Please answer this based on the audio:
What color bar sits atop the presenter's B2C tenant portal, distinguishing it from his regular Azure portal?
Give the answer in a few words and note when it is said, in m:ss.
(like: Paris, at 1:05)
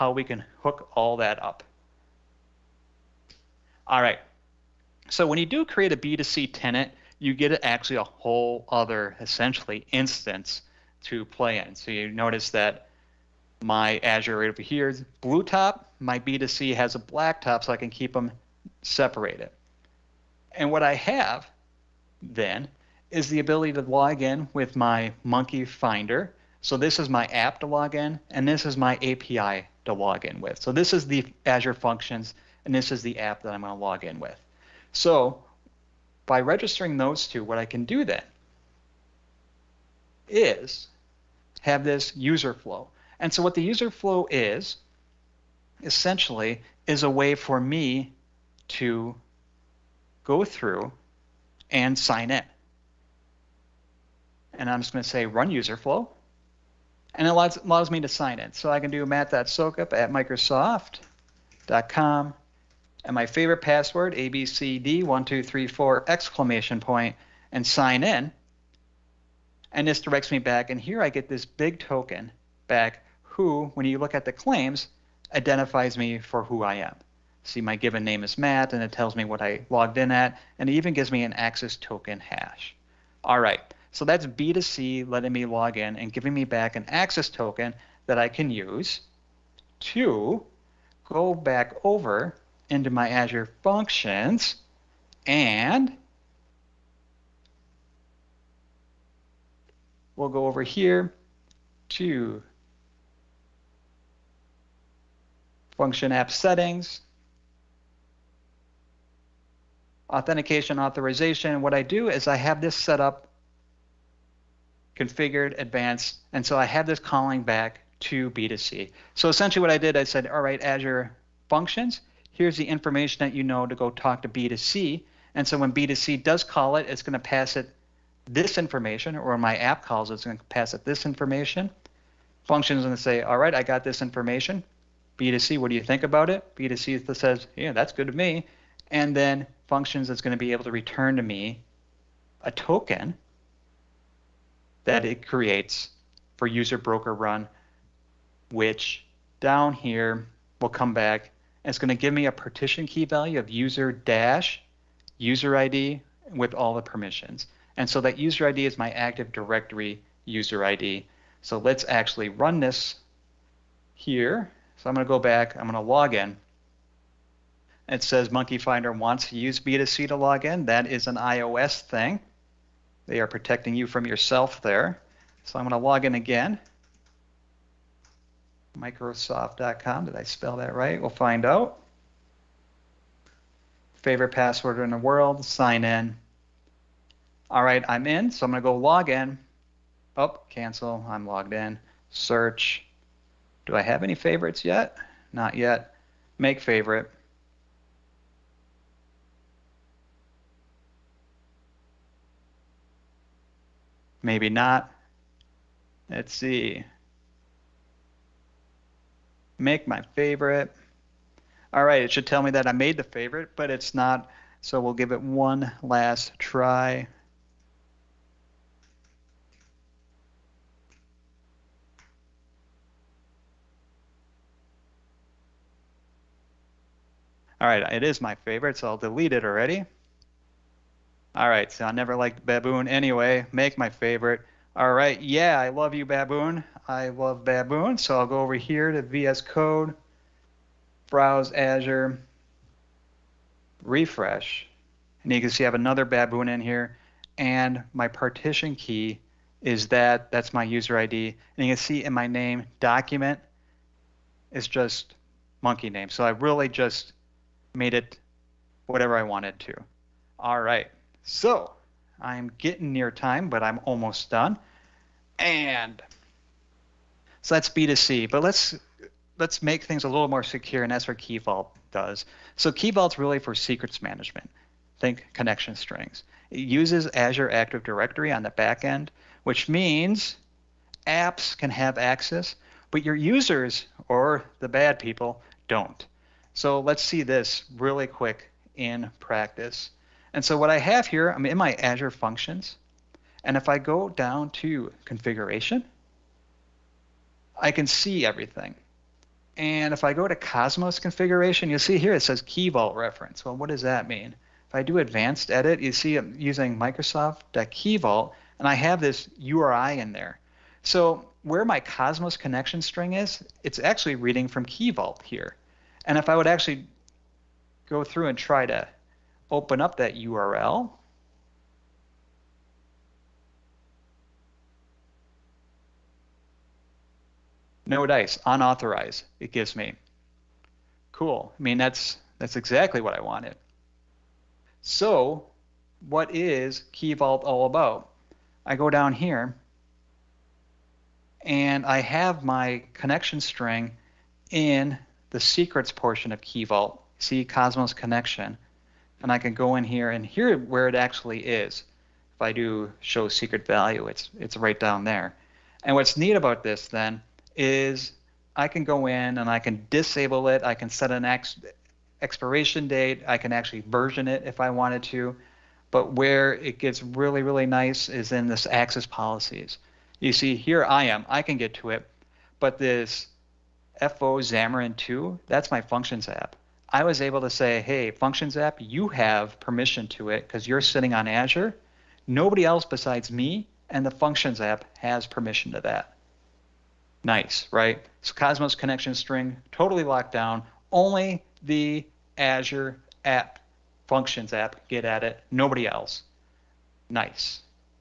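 Black, at 0:16.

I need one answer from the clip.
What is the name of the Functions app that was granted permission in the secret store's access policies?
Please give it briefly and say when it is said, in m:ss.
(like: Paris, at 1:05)
FO Xamarin 2, at 6:13.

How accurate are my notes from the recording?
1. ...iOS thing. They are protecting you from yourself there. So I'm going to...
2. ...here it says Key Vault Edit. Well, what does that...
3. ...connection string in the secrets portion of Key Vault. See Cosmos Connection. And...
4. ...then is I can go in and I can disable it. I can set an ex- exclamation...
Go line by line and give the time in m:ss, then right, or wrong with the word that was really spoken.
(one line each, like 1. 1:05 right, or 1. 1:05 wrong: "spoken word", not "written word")
1. 2:51 right
2. 5:01 wrong: "Reference", not "Edit"
3. 5:42 right
4. 5:56 wrong: "expiration", not "exclamation".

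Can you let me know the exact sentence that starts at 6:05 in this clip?
But where it gets really, really nice is in this access policies.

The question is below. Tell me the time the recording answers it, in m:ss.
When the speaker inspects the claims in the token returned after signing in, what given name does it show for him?
1:18.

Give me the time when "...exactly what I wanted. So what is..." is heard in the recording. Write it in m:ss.
5:32.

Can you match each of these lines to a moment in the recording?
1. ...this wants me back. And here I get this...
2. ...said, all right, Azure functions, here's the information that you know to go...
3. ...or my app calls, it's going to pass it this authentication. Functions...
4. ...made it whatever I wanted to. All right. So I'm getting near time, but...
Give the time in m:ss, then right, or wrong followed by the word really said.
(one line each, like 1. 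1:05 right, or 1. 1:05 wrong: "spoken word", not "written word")
1. 1:09 wrong: "directs", not "wants"
2. 2:00 right
3. 2:09 wrong: "information", not "authentication"
4. 4:17 right.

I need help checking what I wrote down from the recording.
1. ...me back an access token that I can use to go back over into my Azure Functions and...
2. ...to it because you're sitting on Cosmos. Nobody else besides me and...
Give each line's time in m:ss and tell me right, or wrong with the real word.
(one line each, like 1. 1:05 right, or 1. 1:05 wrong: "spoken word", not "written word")
1. 1:26 right
2. 6:20 wrong: "Azure", not "Cosmos".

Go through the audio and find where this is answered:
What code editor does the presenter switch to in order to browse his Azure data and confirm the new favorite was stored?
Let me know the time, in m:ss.
3:59.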